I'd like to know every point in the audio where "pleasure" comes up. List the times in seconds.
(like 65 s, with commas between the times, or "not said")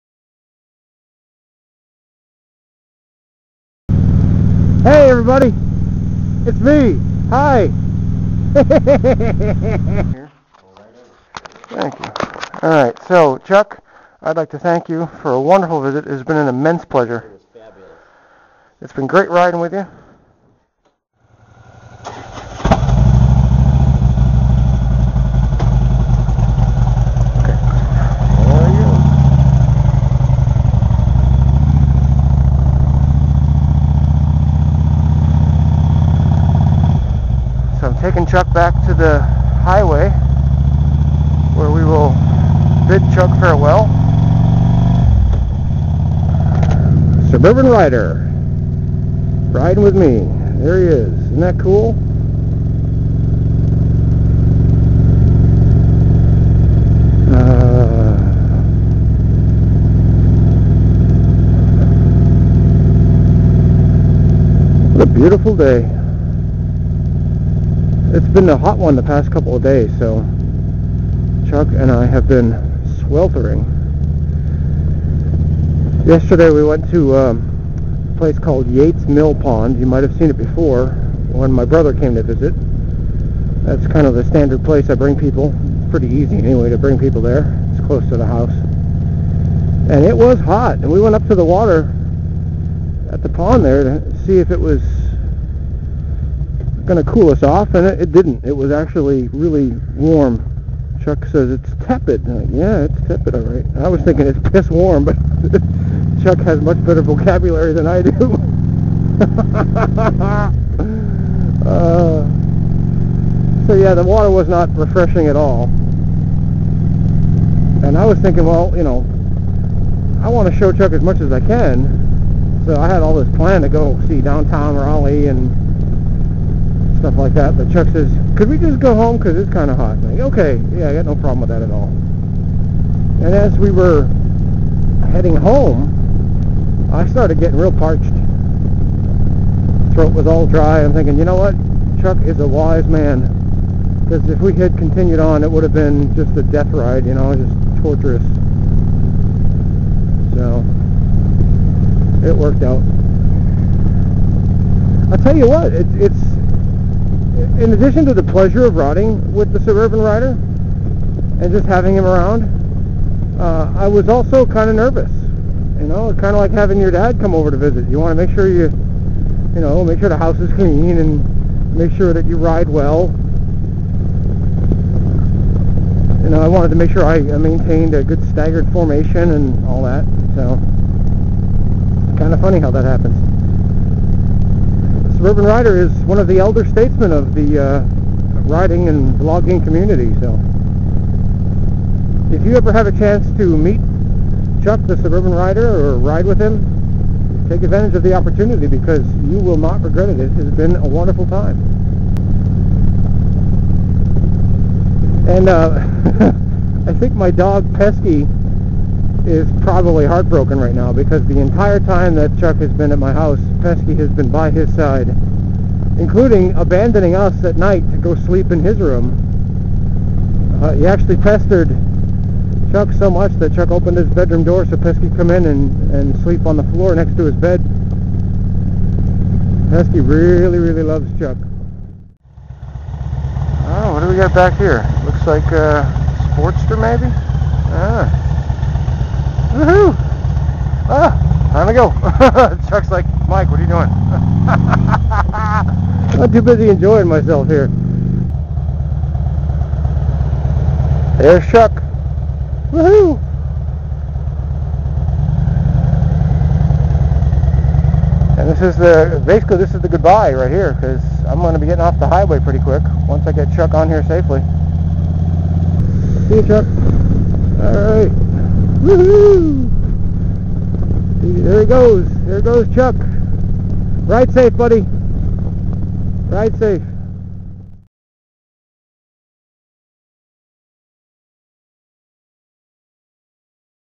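16 s, 158 s.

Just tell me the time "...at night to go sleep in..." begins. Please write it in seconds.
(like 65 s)
217 s.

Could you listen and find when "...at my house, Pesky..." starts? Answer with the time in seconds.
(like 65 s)
212 s.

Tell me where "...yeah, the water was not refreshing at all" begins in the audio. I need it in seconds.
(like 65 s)
113 s.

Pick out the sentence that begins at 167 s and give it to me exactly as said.
You want to make sure you, you know, make sure the house is clean and make sure that you ride well.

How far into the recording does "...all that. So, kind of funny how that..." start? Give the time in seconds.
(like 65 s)
179 s.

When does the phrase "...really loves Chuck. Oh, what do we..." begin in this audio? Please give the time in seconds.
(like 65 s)
230 s.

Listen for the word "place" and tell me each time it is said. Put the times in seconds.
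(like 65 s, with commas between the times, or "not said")
78 s, 84 s.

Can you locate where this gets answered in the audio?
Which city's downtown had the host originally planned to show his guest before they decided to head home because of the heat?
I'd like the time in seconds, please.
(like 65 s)
124 s.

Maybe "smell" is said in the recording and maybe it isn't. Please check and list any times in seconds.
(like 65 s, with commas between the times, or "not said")
not said.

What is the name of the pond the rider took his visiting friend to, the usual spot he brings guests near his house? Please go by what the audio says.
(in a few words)
Yates Mill Pond.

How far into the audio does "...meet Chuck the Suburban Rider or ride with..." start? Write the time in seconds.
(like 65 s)
193 s.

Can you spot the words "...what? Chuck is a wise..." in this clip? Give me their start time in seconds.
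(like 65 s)
141 s.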